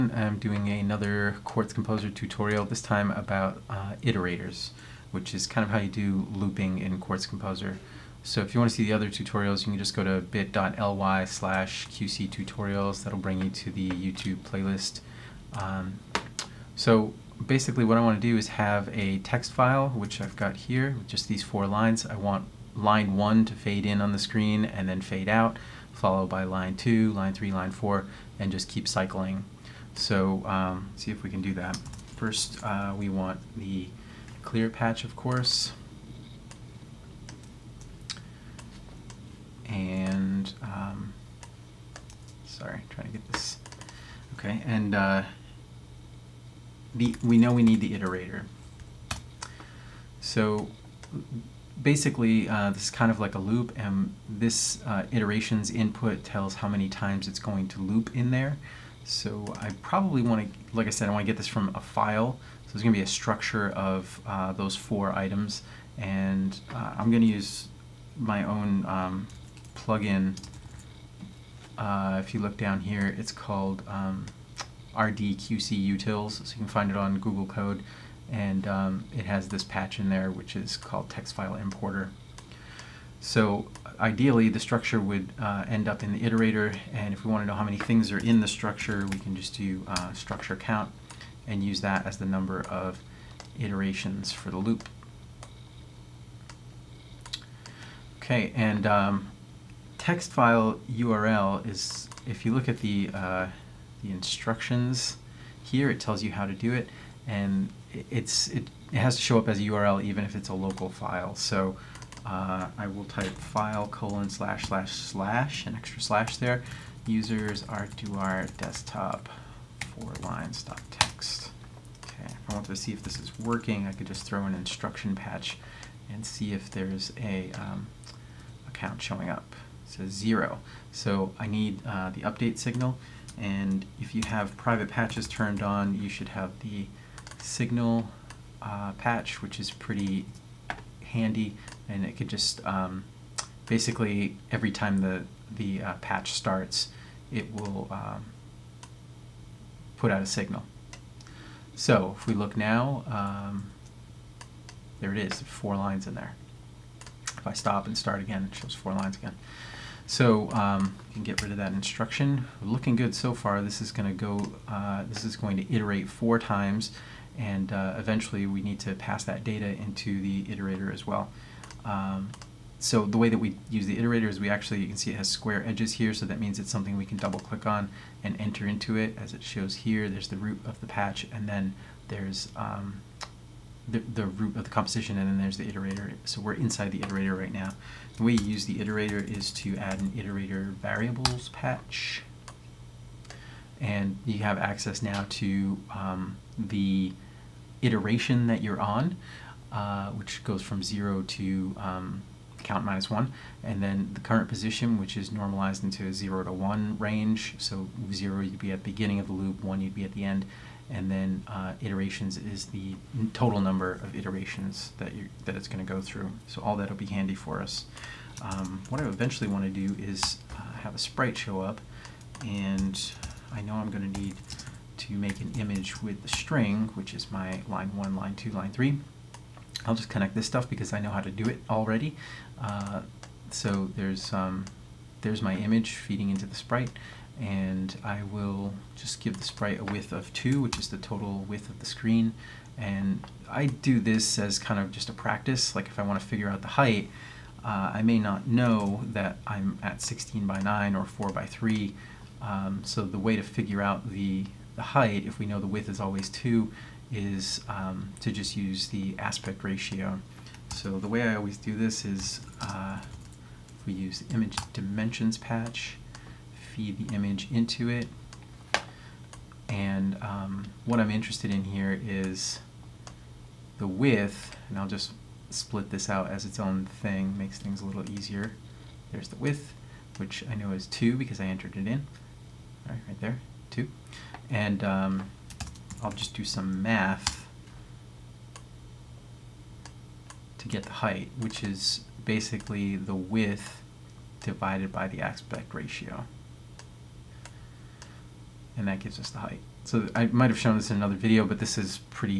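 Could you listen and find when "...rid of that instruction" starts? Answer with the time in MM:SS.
02:41.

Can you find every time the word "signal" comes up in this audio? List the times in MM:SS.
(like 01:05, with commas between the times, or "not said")
02:12, 02:17, 02:30.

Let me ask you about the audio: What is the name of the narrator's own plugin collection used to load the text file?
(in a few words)
RDQC Utils.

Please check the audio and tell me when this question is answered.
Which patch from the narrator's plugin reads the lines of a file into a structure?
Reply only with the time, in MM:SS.
01:21.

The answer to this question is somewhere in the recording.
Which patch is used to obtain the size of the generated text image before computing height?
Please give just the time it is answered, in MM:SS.
04:24.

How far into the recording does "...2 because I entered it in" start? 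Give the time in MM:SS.
04:40.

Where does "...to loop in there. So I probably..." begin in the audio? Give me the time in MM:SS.
00:57.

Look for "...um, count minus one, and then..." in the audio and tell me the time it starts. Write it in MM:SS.
03:21.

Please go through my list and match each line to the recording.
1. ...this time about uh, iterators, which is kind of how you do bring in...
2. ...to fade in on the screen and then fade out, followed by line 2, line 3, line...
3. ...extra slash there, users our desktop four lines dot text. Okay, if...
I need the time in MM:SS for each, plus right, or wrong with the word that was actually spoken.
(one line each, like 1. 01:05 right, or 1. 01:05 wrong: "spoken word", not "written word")
1. 00:02 wrong: "looping", not "bring"
2. 00:23 right
3. 01:55 right.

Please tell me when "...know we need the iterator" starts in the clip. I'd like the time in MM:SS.
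00:47.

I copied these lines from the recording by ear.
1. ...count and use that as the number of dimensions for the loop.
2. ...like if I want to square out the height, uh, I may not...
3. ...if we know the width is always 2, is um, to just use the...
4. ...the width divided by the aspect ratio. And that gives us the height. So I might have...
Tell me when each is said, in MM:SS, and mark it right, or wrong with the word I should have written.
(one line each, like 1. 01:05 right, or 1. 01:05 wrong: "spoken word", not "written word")
1. 01:30 wrong: "iterations", not "dimensions"
2. 04:05 wrong: "figure", not "square"
3. 04:15 right
4. 04:52 right.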